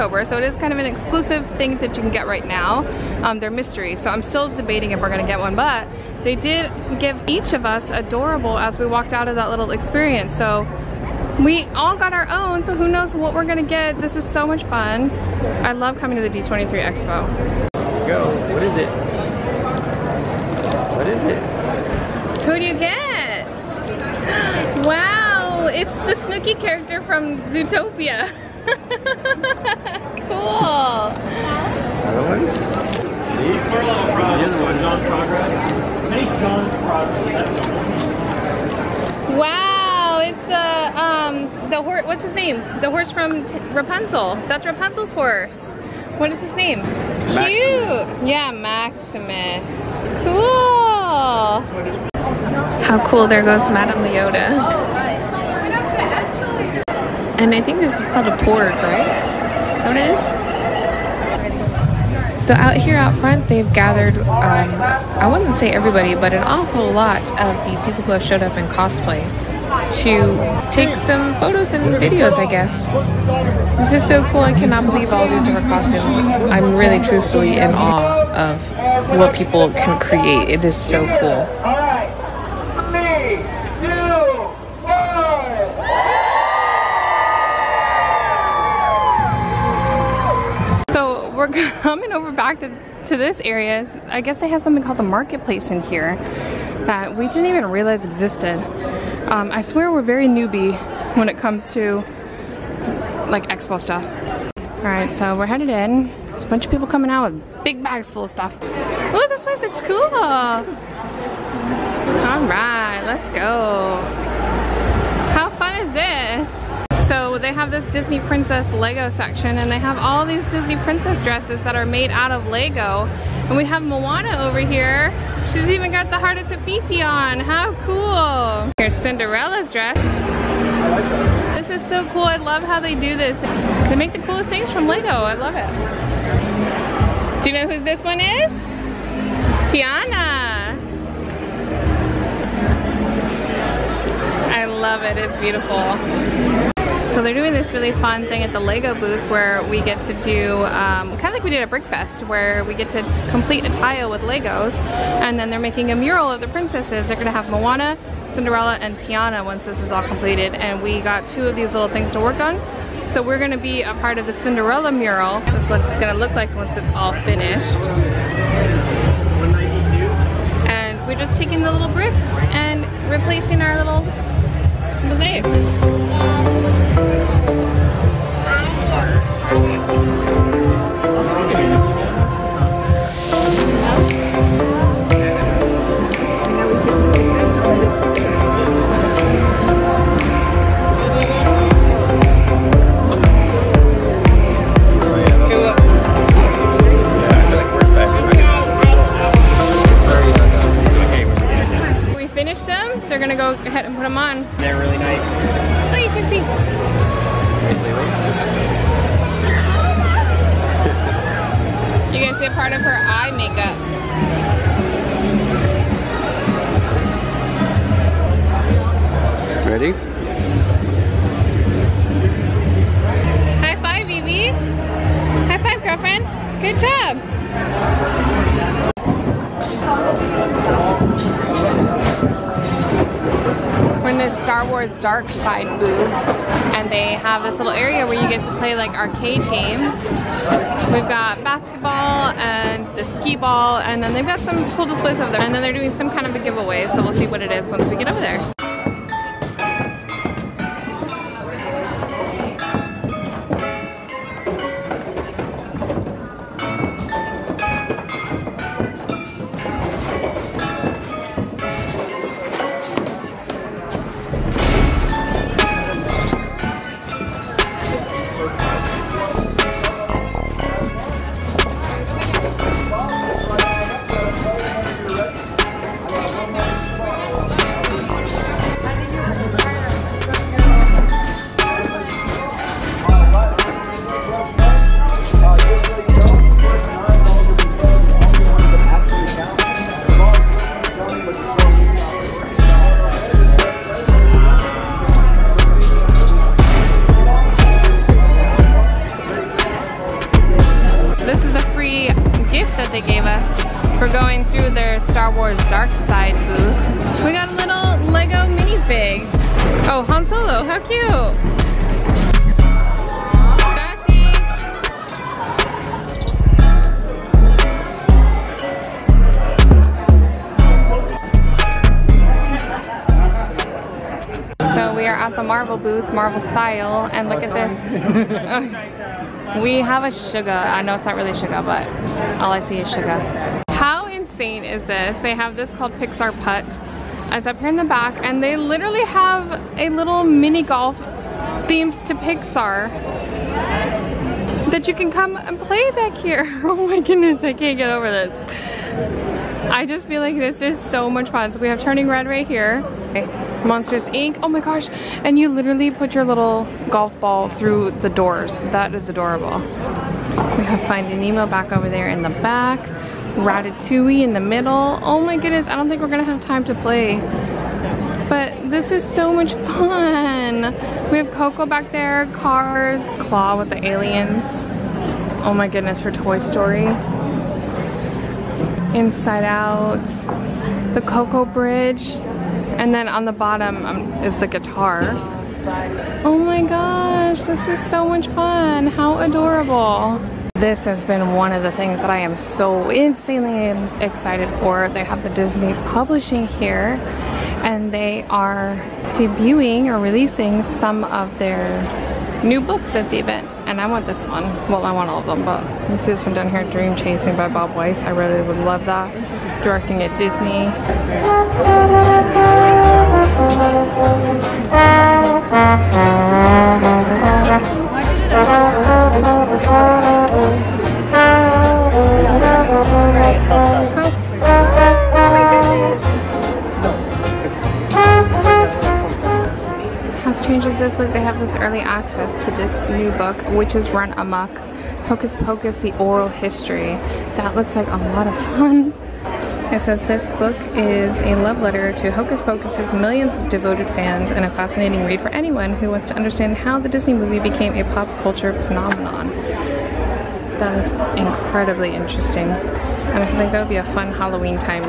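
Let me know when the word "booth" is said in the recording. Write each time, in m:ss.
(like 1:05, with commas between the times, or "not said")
2:28, 3:55.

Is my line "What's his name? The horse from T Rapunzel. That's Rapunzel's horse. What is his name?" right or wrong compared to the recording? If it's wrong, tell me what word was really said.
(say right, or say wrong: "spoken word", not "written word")
right.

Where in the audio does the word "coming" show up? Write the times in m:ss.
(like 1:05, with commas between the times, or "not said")
0:15, 1:31, 1:46.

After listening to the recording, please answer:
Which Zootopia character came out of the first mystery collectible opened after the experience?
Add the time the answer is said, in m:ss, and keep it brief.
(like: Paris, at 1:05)
Snooky, at 0:26.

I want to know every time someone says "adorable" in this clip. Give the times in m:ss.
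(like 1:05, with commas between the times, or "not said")
0:07, 5:59, 6:29.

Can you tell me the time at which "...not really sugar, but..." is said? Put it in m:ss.
5:31.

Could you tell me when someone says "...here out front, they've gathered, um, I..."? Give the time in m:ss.
1:02.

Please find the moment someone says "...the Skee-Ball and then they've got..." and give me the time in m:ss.
4:02.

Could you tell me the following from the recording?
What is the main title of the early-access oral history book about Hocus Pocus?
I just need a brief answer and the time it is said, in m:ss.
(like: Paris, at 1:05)
Witches Run Amok, at 7:13.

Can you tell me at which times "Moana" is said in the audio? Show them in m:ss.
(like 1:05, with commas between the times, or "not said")
2:03, 2:37.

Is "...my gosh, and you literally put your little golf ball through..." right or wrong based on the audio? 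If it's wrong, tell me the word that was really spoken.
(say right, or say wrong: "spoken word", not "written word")
right.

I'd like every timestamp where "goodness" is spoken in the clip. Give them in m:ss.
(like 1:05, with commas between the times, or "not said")
5:47, 6:05, 6:15.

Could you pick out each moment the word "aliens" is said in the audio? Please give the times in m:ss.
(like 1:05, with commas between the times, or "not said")
6:13.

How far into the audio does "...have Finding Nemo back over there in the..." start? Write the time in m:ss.
6:00.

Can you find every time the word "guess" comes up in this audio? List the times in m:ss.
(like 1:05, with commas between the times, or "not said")
1:12, 1:34.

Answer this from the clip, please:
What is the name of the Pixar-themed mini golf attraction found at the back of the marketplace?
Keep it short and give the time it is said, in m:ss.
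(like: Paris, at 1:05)
Pixar Putt, at 5:35.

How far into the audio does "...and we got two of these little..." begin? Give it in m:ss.
2:40.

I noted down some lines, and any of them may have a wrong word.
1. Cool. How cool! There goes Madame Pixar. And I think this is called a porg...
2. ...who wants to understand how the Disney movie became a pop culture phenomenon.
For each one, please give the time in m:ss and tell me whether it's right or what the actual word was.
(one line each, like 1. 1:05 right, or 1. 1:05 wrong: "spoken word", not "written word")
1. 0:50 wrong: "Leota", not "Pixar"
2. 7:25 right.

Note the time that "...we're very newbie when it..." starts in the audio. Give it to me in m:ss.
1:39.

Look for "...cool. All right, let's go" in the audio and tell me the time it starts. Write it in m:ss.
1:49.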